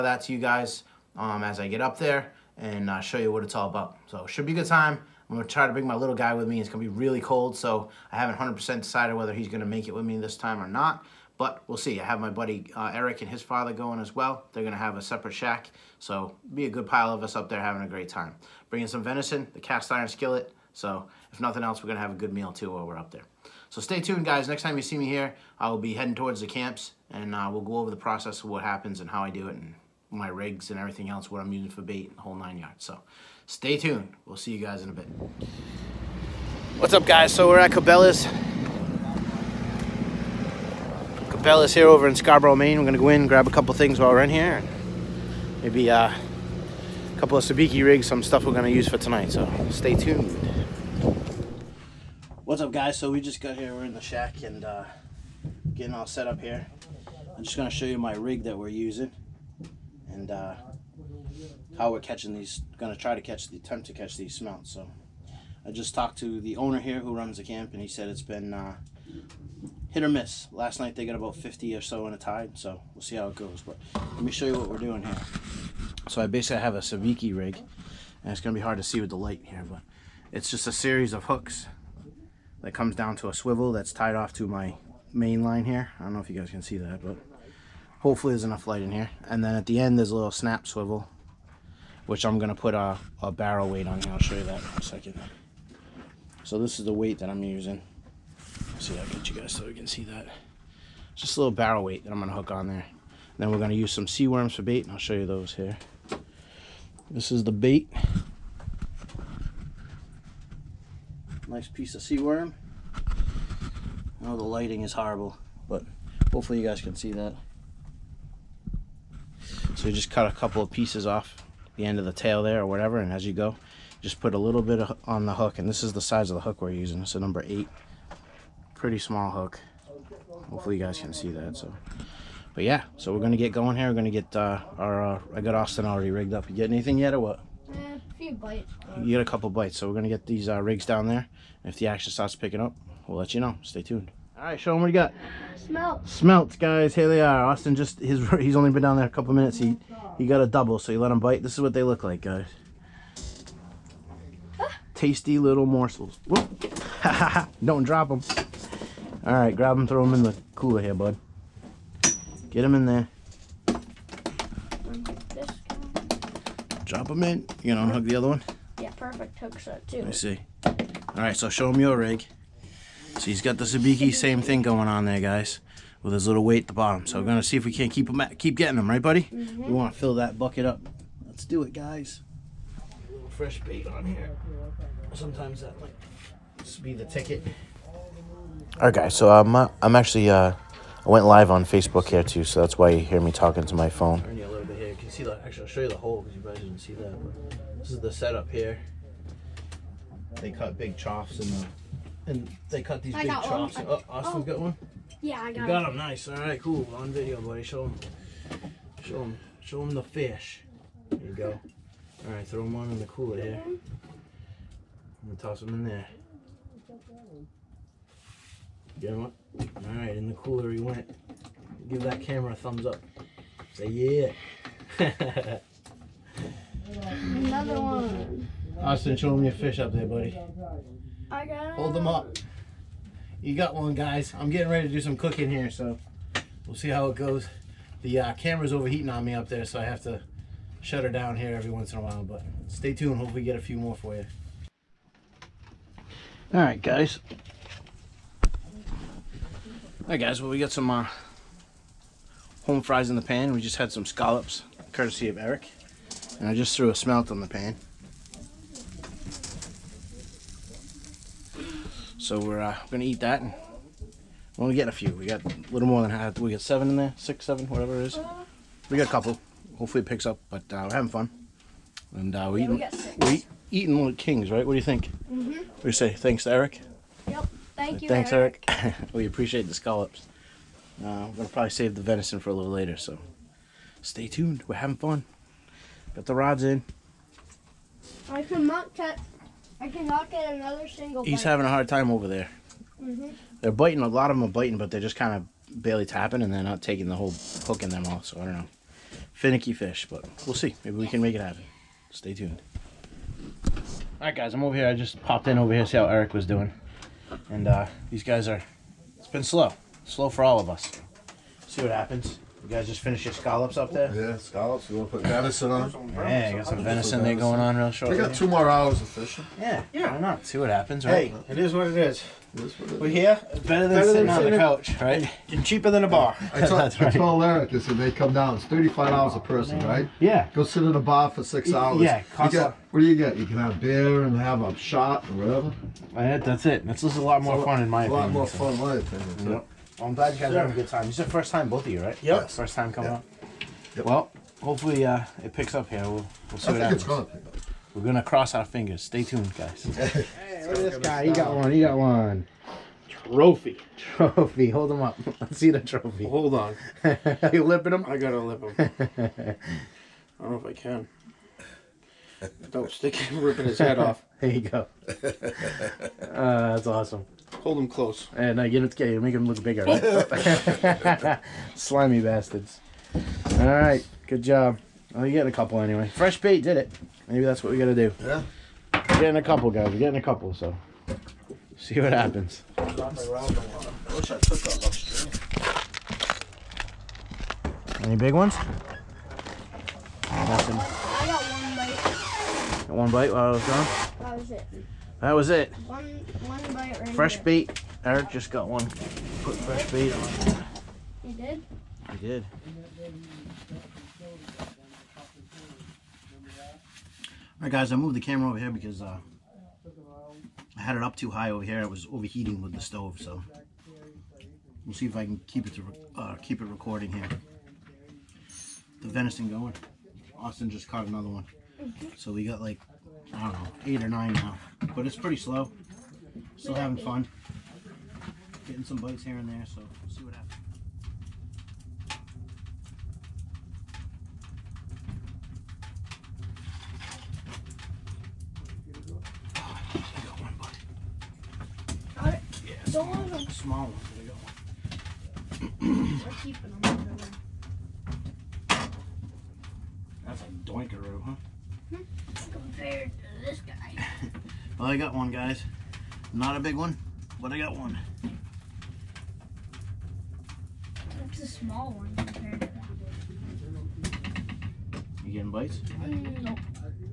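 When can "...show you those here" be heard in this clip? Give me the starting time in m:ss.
1:44.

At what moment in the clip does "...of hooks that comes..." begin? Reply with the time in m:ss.
1:21.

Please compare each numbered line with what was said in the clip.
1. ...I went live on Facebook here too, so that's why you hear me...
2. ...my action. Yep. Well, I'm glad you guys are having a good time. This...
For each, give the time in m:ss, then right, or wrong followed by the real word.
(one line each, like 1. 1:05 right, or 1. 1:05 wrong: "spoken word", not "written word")
1. 3:11 right
2. 5:38 wrong: "opinion", not "action".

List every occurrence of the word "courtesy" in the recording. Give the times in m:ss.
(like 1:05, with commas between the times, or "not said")
4:14.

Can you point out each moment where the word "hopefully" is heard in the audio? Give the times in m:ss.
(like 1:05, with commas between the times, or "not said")
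1:27, 1:56, 2:10, 4:03, 4:29, 5:44.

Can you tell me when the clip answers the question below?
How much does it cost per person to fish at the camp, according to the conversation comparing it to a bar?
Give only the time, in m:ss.
5:28.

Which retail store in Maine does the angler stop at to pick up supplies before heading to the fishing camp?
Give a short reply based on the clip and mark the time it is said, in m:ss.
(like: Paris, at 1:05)
Cabela's, at 0:41.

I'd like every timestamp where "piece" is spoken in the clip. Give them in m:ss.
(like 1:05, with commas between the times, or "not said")
1:51, 2:00.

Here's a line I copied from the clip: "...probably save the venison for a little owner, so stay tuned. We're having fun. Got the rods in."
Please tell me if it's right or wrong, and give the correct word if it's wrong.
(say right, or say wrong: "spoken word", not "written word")
wrong: "later", not "owner".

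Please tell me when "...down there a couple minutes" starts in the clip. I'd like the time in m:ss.
2:28.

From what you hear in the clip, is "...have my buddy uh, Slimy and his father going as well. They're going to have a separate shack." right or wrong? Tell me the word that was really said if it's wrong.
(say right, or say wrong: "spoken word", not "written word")
wrong: "Eric", not "Slimy".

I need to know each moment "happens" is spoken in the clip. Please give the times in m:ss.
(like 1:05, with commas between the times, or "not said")
0:28, 5:01, 5:11, 5:20, 5:46, 6:22, 7:10.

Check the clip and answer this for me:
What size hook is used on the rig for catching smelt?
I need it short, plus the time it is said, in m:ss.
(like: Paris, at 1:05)
number 8, at 2:07.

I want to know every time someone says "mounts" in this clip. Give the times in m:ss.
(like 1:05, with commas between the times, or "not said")
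1:04.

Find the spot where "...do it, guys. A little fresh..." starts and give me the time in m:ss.
3:01.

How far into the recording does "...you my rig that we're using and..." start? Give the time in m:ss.
0:57.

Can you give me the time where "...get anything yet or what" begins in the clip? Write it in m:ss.
2:16.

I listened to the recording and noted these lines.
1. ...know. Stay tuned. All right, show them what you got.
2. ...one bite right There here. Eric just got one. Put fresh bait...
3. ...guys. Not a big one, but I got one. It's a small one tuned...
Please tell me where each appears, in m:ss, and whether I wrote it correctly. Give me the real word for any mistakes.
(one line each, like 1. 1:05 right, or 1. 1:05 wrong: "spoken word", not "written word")
1. 2:23 right
2. 6:36 wrong: "Fresh", not "There"
3. 7:35 wrong: "compared", not "tuned".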